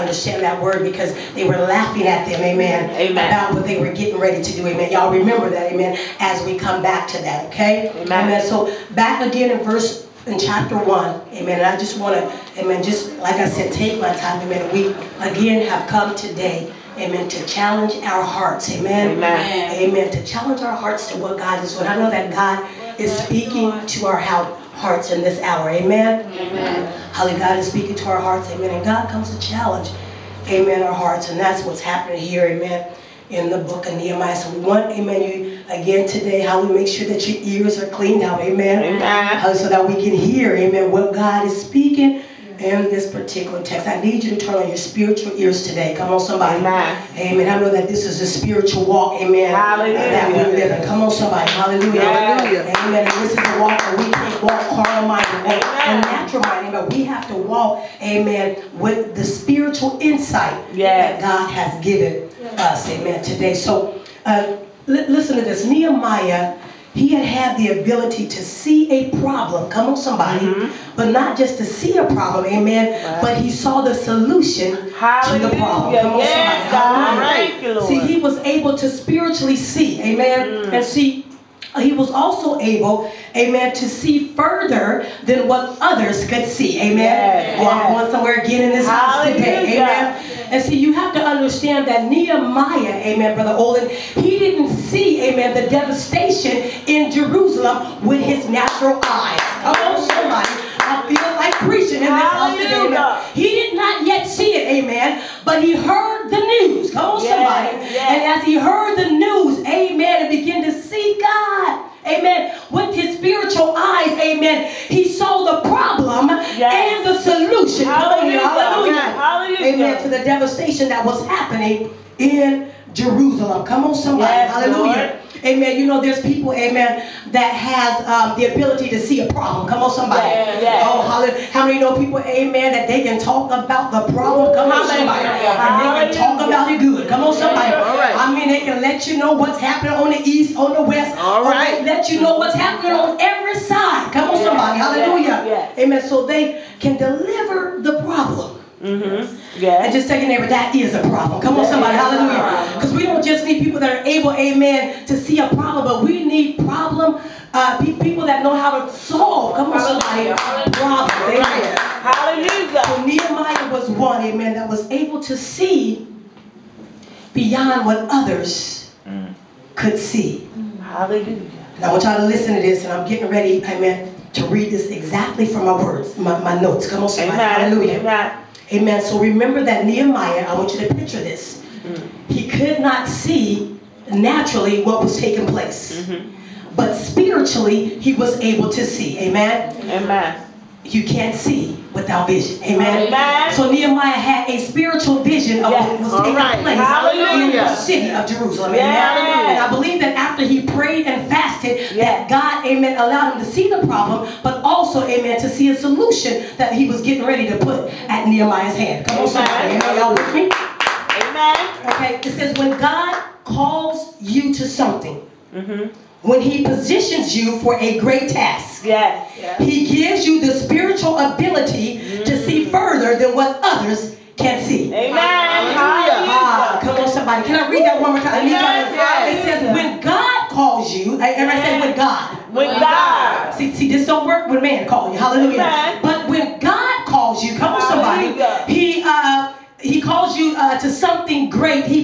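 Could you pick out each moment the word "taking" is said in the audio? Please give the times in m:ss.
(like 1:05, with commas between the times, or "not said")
3:05, 3:16.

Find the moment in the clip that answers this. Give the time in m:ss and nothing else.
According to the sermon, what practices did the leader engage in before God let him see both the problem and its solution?
3:20.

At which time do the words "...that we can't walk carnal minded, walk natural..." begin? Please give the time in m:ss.
0:53.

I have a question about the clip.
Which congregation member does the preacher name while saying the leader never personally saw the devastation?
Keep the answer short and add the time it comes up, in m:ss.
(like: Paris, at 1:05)
Brother Olin, at 1:33.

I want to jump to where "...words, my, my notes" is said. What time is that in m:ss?
2:55.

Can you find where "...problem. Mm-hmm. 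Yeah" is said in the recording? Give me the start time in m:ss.
2:28.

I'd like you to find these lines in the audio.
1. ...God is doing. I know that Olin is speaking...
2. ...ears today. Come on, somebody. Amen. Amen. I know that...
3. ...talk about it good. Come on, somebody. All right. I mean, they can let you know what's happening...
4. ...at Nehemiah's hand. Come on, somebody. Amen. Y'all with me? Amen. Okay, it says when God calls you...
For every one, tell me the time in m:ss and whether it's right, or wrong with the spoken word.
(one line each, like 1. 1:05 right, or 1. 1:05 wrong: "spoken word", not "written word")
1. 0:21 wrong: "God", not "Olin"
2. 0:45 right
3. 2:16 right
4. 3:28 right.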